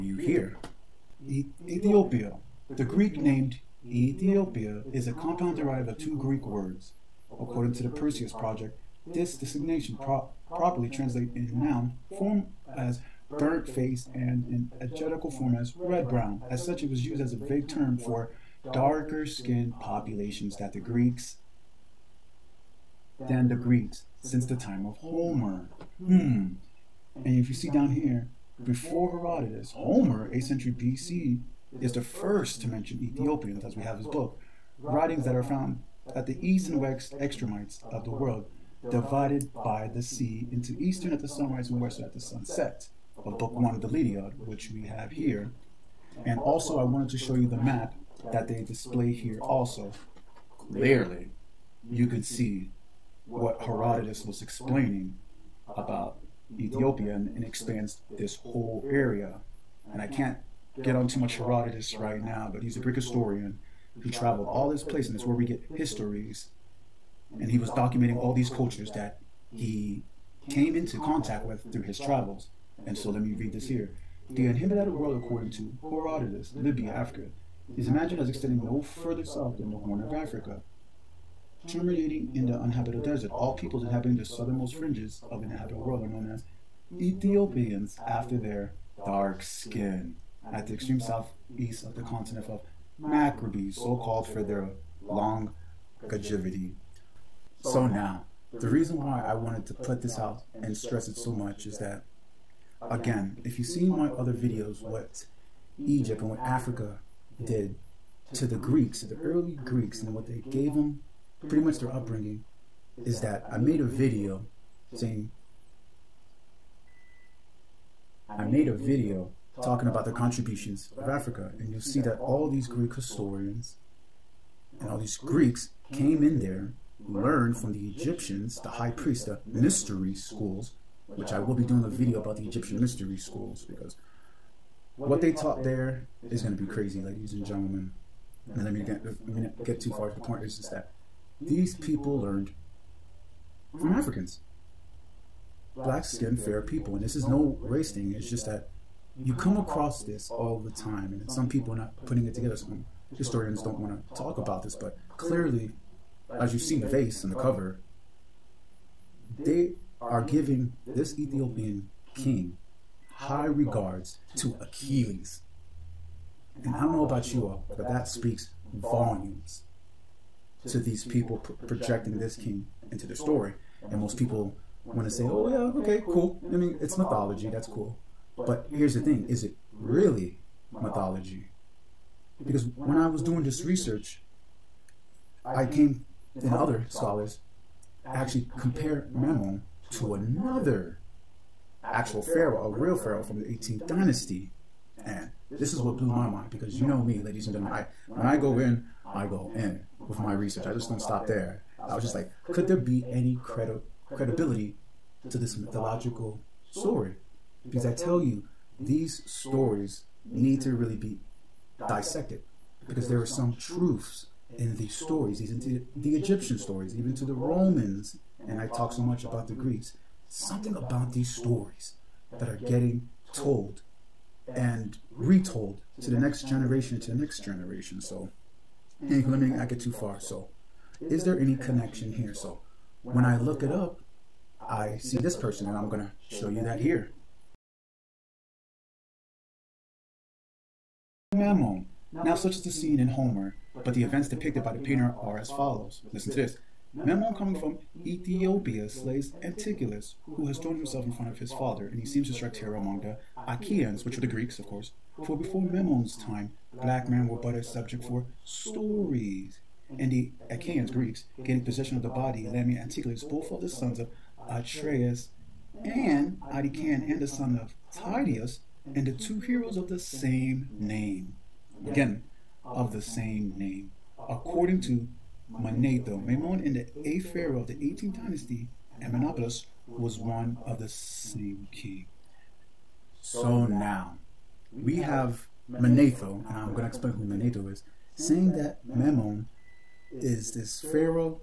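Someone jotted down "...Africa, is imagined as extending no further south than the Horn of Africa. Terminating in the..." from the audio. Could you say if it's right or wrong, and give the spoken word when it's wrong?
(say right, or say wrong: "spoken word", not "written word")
right.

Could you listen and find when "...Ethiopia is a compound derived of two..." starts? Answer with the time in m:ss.
0:03.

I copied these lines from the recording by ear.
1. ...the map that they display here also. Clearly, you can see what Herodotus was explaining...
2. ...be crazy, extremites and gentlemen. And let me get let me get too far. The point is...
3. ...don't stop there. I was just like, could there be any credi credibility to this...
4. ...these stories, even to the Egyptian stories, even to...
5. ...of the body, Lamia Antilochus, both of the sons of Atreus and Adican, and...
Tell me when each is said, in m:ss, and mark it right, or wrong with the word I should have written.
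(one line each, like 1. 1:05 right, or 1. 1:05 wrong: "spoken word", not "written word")
1. 0:47 right
2. 2:16 wrong: "ladies", not "extremites"
3. 3:20 right
4. 3:34 right
5. 4:21 right.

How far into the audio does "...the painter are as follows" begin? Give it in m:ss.
4:04.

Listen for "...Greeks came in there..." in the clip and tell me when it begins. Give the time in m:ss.
2:05.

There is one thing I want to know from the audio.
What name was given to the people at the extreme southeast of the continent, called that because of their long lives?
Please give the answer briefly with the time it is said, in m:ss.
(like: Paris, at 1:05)
Macrobes, at 1:33.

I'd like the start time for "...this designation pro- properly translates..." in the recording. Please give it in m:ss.
0:09.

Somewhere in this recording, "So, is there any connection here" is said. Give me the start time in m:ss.
3:50.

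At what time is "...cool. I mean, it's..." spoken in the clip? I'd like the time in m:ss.
2:56.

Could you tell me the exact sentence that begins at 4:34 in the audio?
According to Manetho, Memnon in the eighth pharaoh of the 18th dynasty, and was one of the same king.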